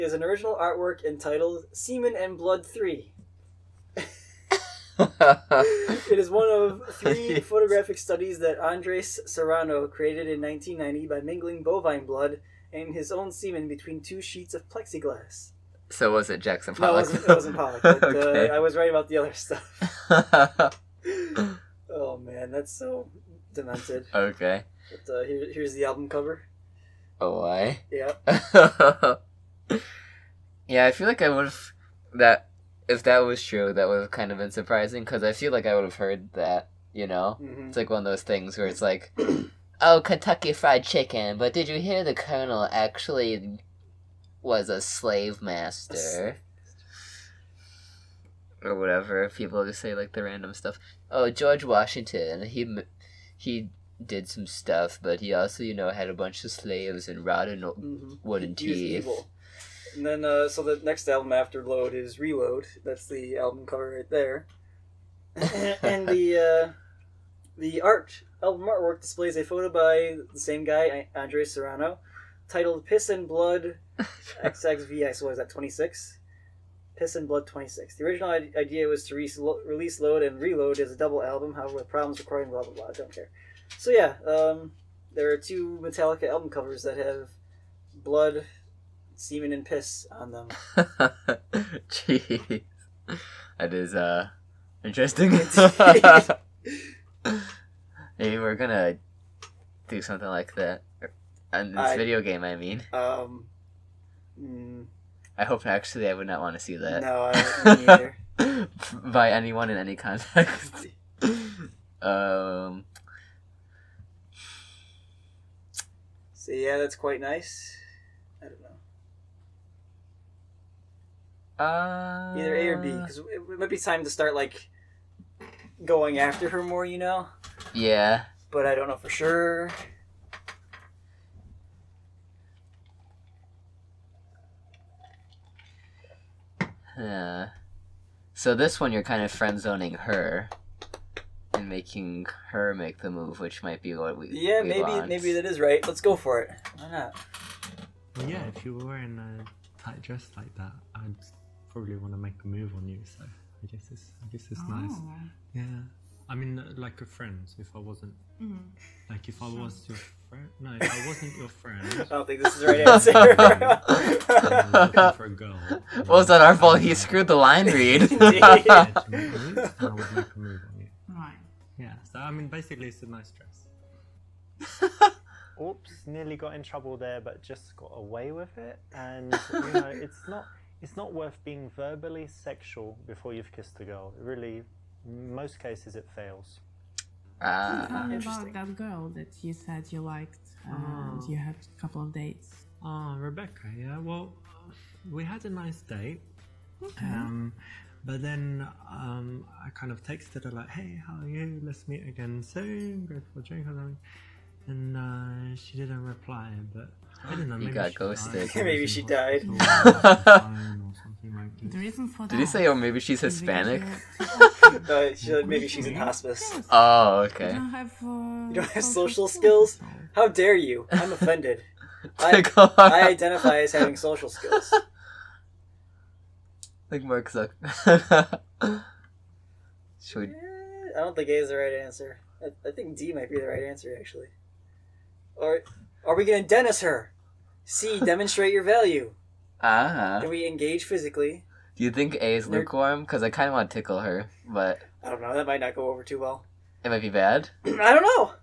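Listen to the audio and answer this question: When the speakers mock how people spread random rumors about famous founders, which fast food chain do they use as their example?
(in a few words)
Kentucky Fried Chicken.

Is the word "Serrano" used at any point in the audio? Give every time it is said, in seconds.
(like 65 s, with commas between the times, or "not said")
9 s, 71 s.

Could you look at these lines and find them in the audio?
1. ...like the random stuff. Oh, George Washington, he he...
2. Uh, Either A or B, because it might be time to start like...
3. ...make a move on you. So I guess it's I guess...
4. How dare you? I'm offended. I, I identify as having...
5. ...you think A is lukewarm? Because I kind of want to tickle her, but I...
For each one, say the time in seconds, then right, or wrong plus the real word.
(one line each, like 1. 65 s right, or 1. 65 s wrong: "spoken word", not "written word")
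1. 49 s right
2. 121 s right
3. 152 s right
4. 220 s right
5. 241 s right.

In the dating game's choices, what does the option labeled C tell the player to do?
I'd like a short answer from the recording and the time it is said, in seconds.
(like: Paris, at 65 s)
Demonstrate your value, at 238 s.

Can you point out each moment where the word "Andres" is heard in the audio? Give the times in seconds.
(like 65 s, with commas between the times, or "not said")
8 s, 71 s.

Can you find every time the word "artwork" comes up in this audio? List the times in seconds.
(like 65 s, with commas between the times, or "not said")
0 s, 68 s.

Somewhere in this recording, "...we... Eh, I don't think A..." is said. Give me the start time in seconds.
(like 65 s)
230 s.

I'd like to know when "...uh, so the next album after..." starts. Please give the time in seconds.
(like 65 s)
60 s.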